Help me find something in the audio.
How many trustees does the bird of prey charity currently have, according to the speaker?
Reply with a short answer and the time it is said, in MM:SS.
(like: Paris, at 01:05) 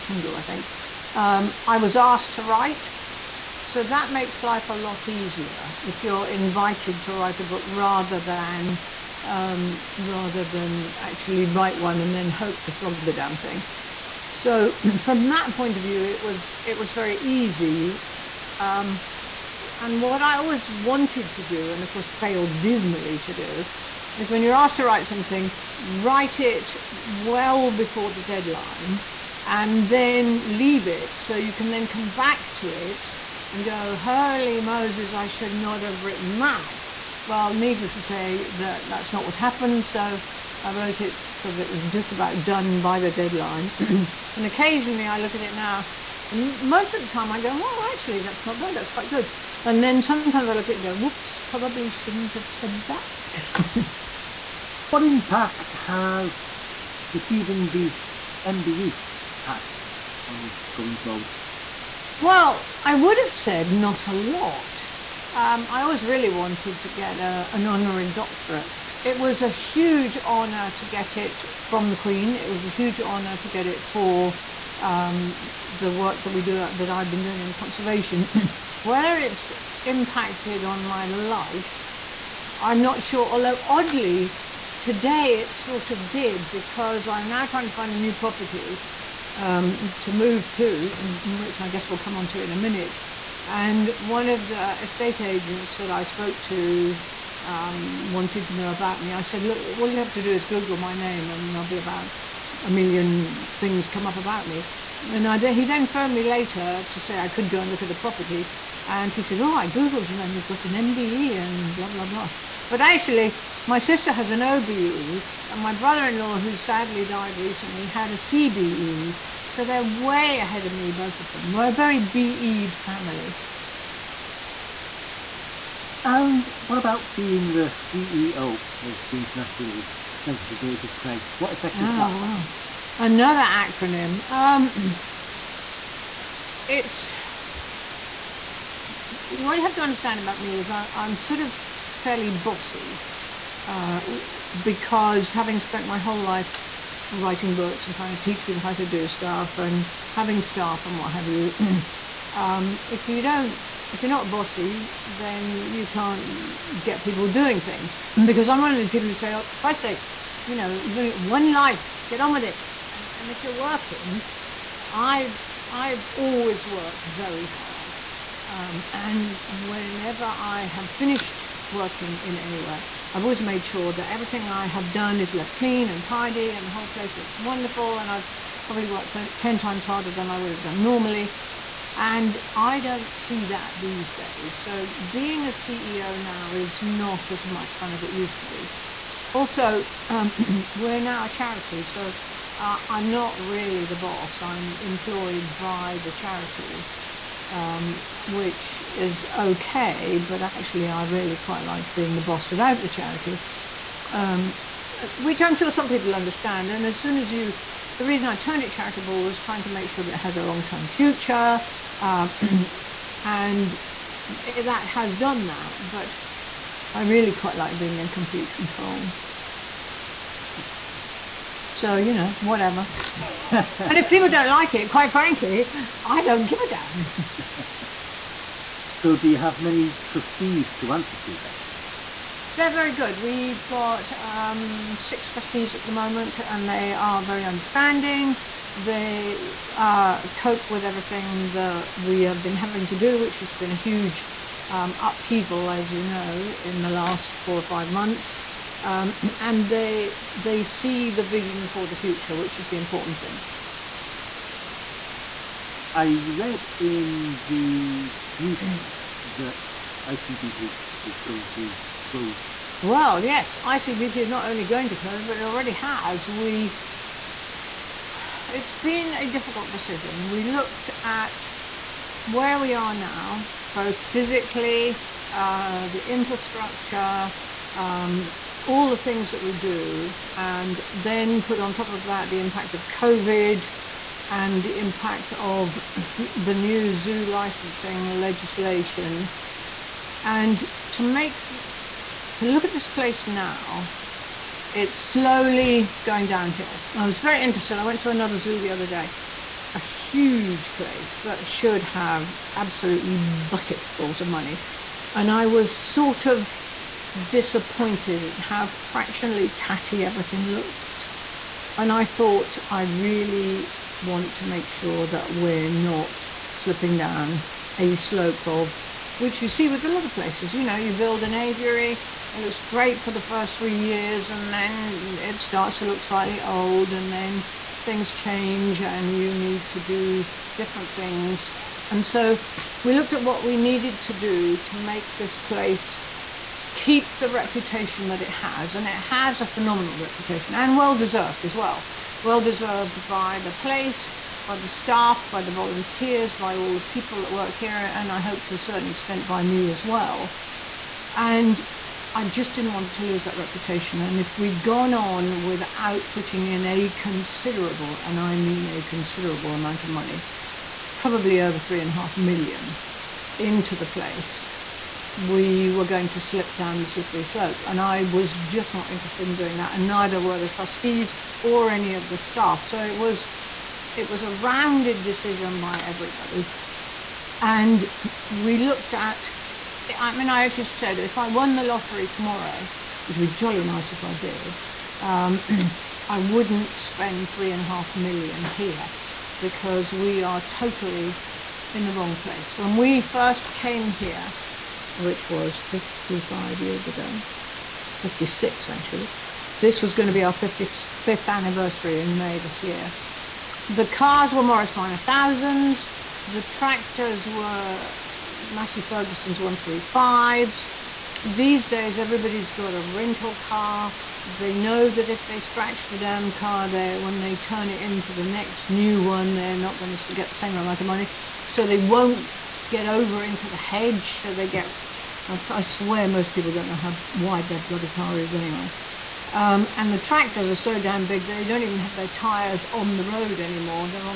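6, at 03:54.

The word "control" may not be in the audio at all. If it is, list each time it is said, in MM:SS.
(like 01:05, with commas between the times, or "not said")
03:38.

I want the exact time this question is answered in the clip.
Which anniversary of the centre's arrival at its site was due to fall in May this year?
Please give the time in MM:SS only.
06:40.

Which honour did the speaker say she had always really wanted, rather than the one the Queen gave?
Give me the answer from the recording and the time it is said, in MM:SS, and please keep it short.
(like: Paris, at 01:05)
Honorary doctorate, at 01:07.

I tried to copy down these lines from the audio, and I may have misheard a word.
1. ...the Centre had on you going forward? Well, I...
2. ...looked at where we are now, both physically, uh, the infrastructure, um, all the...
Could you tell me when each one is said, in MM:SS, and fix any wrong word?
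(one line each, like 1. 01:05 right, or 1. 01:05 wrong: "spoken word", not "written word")
1. 00:57 wrong: "MBE", not "Centre"
2. 04:30 right.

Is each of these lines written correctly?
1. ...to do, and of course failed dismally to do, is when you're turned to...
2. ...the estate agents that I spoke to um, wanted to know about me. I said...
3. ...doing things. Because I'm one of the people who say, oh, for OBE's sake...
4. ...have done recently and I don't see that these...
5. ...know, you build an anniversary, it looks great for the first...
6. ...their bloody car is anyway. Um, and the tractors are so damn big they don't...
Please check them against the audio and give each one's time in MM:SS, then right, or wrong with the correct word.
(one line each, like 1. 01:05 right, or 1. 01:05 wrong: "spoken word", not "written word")
1. 00:21 wrong: "asked", not "turned"
2. 01:34 right
3. 02:37 wrong: "Christ", not "OBE"
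4. 03:00 wrong: "normally", not "recently"
5. 05:20 wrong: "aviary", not "anniversary"
6. 07:07 right.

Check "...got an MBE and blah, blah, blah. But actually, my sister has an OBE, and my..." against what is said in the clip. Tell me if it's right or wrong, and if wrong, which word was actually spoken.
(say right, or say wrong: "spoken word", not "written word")
right.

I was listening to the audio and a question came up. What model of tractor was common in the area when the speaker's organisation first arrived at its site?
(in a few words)
Massey Ferguson 135.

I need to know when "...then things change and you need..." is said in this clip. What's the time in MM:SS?
05:27.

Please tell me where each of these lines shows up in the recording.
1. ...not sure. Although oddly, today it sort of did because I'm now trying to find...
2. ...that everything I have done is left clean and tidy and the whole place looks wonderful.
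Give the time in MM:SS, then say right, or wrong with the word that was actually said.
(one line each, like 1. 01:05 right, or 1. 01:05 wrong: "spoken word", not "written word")
1. 01:22 right
2. 02:53 right.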